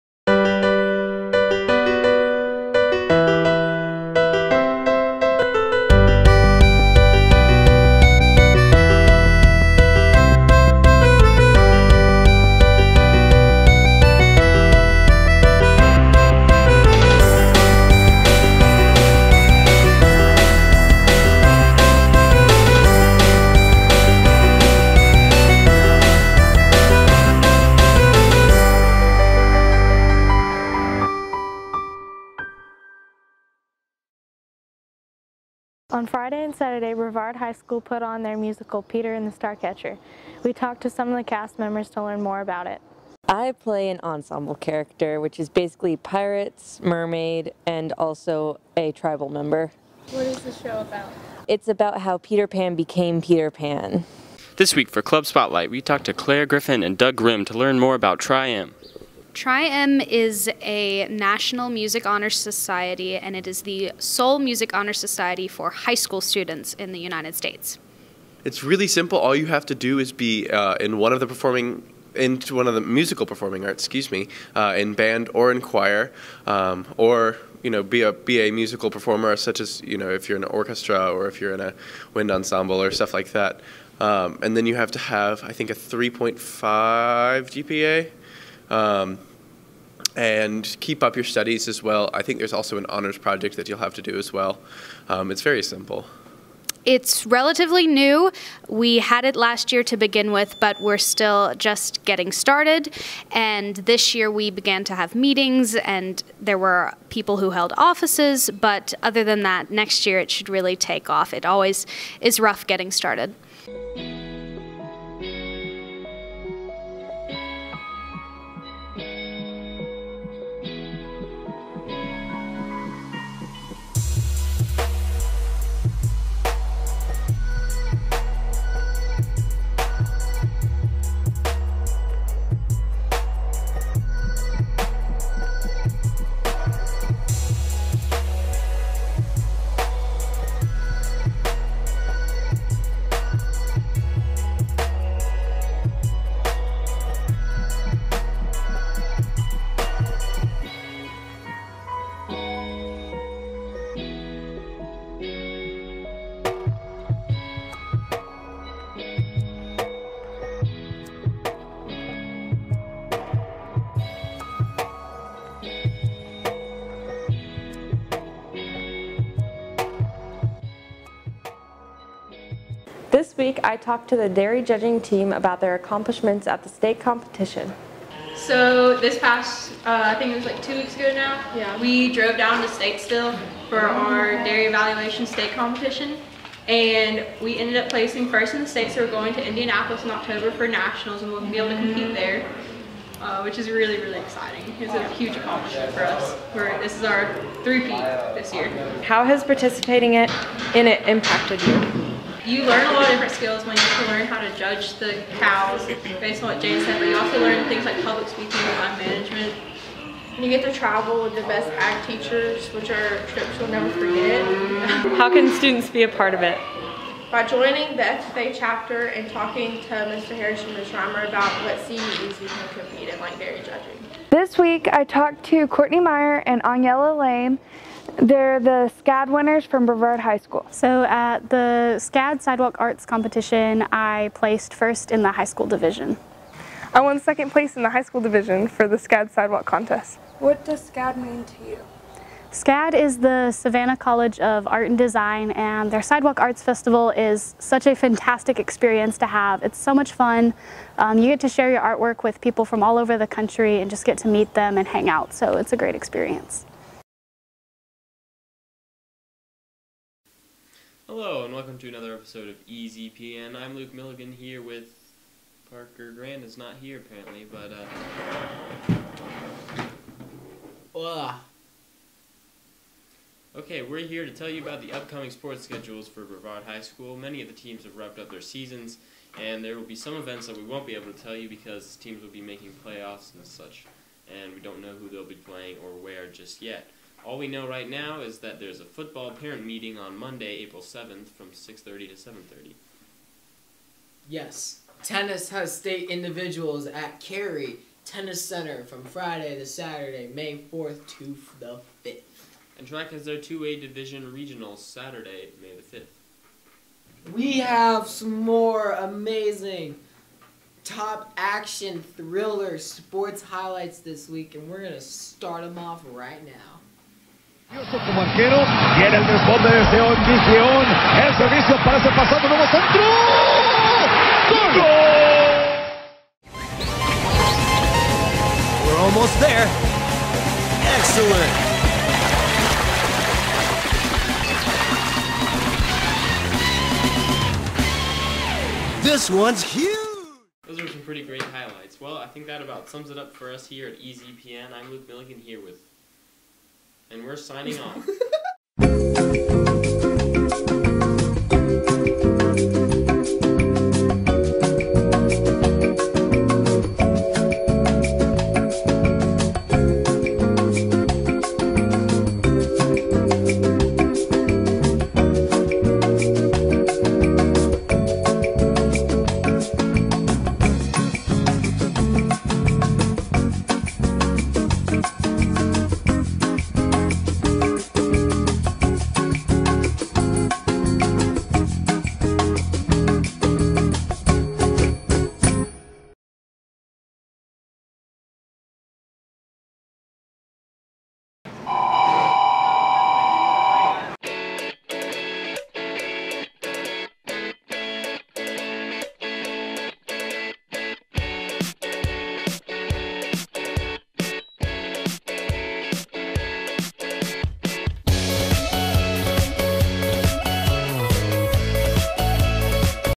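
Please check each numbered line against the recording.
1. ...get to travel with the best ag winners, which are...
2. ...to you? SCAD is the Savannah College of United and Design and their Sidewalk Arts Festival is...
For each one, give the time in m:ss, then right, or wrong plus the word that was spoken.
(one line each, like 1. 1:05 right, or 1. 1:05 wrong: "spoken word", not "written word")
1. 3:30 wrong: "teachers", not "winners"
2. 4:01 wrong: "Art", not "United".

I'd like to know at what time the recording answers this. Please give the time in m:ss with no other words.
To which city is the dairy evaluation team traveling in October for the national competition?
3:09.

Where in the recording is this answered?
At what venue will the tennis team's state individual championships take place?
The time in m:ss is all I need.
4:57.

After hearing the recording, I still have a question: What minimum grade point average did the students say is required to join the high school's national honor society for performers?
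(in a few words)
3.5.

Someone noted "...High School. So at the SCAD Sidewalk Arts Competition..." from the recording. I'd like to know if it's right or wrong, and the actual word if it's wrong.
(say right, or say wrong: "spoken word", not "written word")
right.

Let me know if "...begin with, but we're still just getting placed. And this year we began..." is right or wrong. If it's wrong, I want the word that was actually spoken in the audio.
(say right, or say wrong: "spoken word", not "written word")
wrong: "started", not "placed".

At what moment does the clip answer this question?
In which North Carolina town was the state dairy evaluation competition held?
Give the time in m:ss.
3:02.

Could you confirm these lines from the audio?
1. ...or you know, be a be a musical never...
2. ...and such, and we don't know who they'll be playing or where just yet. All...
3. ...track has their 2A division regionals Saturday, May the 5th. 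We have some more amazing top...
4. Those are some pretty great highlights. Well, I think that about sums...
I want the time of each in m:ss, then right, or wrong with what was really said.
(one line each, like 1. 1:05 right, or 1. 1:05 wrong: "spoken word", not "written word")
1. 1:16 wrong: "performer", not "never"
2. 4:43 right
3. 5:02 right
4. 5:40 right.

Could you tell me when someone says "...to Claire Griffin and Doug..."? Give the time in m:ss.
0:56.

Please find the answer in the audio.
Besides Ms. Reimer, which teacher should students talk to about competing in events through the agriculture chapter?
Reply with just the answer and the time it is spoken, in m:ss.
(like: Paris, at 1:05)
Mr. Harris, at 3:40.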